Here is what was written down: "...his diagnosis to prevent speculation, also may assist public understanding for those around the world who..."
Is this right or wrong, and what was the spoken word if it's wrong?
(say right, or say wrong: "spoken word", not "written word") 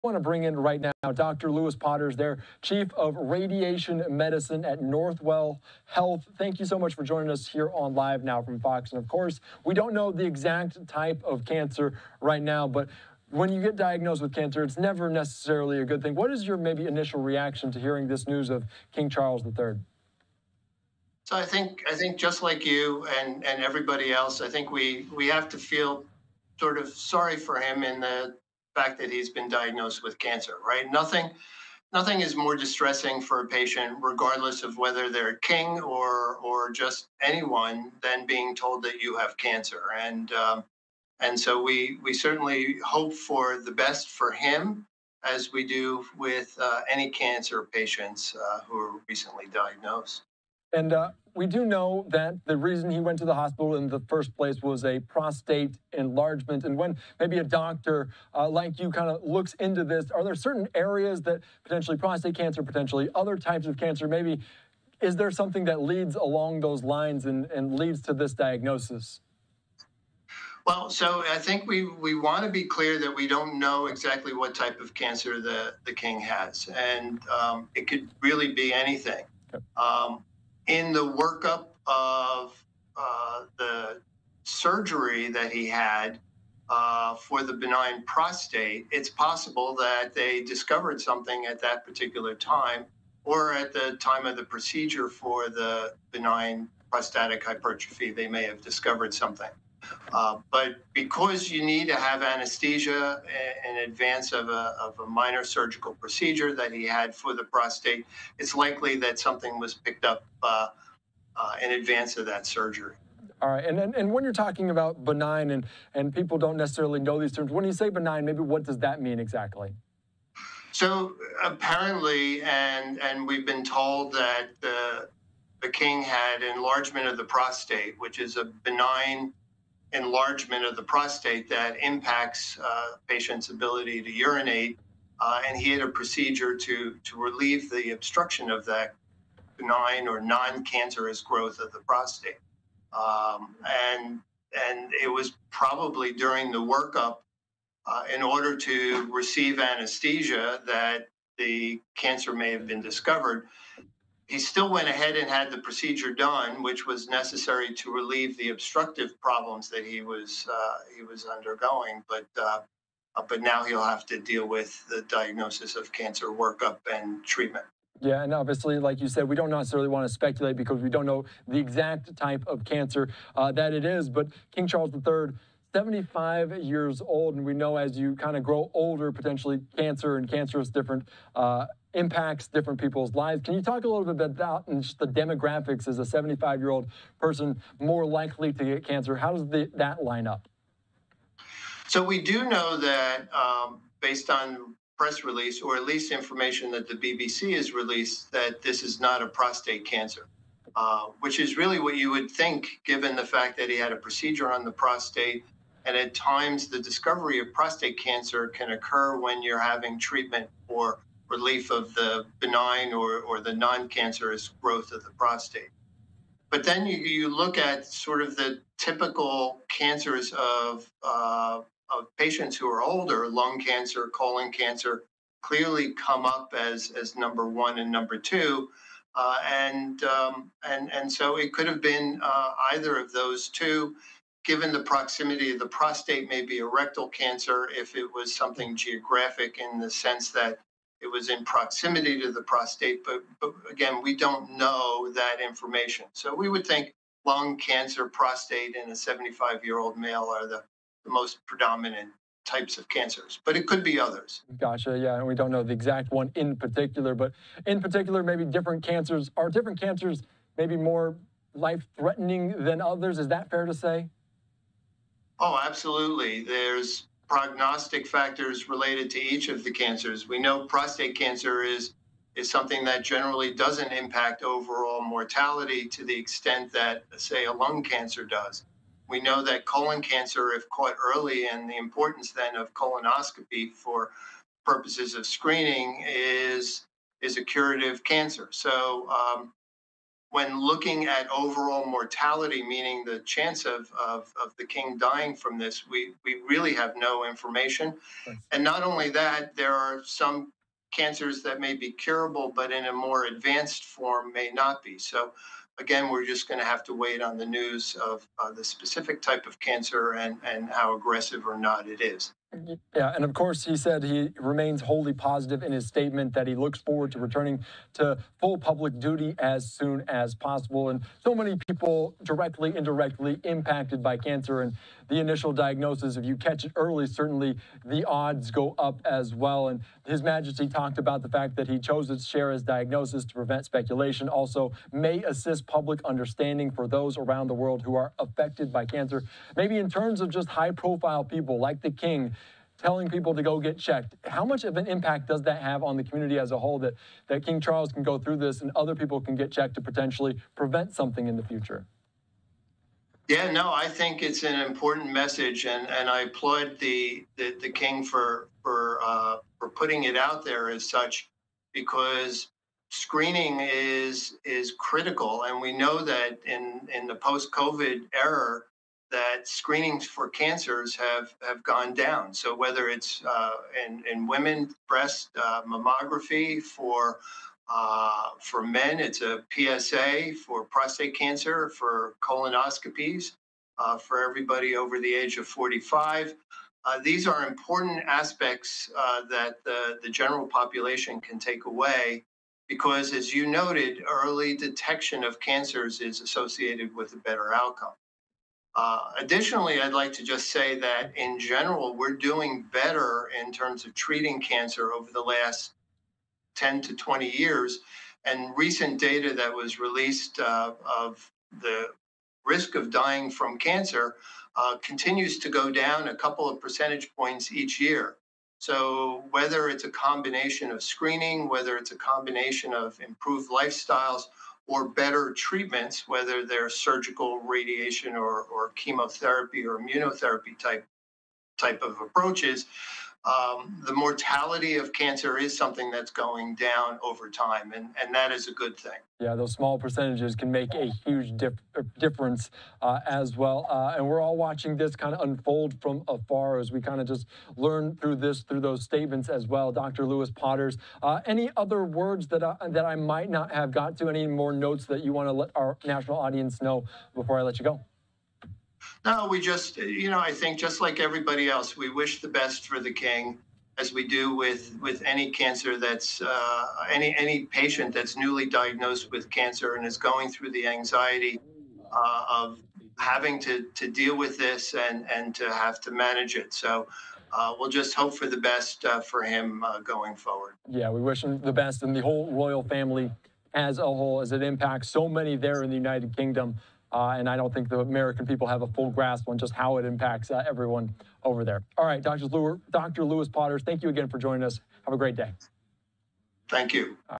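right.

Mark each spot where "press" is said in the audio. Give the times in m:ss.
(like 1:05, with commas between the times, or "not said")
3:14.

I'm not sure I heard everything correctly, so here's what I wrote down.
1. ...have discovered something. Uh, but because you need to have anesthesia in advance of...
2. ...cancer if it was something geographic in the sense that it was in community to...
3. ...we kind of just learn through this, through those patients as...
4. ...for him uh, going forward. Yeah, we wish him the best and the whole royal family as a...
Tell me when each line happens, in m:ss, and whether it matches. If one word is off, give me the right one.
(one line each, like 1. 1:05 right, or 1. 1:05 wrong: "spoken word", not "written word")
1. 1:38 right
2. 3:57 wrong: "proximity", not "community"
3. 7:26 wrong: "statements", not "patients"
4. 7:58 right.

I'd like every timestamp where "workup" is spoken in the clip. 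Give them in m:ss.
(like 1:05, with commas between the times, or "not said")
1:21, 2:26, 2:46.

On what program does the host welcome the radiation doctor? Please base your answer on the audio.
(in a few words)
Live Now from Fox.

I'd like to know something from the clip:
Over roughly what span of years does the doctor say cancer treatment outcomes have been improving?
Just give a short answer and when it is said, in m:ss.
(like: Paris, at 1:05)
10 to 20 years, at 6:46.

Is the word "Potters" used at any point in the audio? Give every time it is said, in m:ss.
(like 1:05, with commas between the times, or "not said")
0:01, 7:30, 8:13.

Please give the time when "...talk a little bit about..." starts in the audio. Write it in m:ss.
3:03.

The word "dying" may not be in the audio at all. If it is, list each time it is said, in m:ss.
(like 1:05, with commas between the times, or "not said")
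4:54, 6:52.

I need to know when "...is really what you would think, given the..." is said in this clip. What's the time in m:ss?
3:21.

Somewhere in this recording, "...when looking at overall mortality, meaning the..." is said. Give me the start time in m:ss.
4:50.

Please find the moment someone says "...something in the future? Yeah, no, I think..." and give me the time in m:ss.
5:50.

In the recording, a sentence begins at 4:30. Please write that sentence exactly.
We know prostate cancer is is something that generally doesn't impact overall mortality to the extent that, say, a lung cancer does.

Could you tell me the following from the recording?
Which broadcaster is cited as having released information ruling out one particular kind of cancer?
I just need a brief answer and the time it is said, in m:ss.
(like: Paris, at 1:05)
BBC, at 3:16.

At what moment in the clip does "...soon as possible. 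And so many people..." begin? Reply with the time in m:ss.
5:19.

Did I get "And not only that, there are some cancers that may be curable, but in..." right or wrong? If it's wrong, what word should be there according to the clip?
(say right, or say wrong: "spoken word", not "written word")
right.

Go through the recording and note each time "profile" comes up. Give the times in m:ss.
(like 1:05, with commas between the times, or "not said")
5:40.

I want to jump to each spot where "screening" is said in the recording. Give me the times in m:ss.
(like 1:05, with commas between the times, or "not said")
4:45, 6:02, 6:09, 7:00.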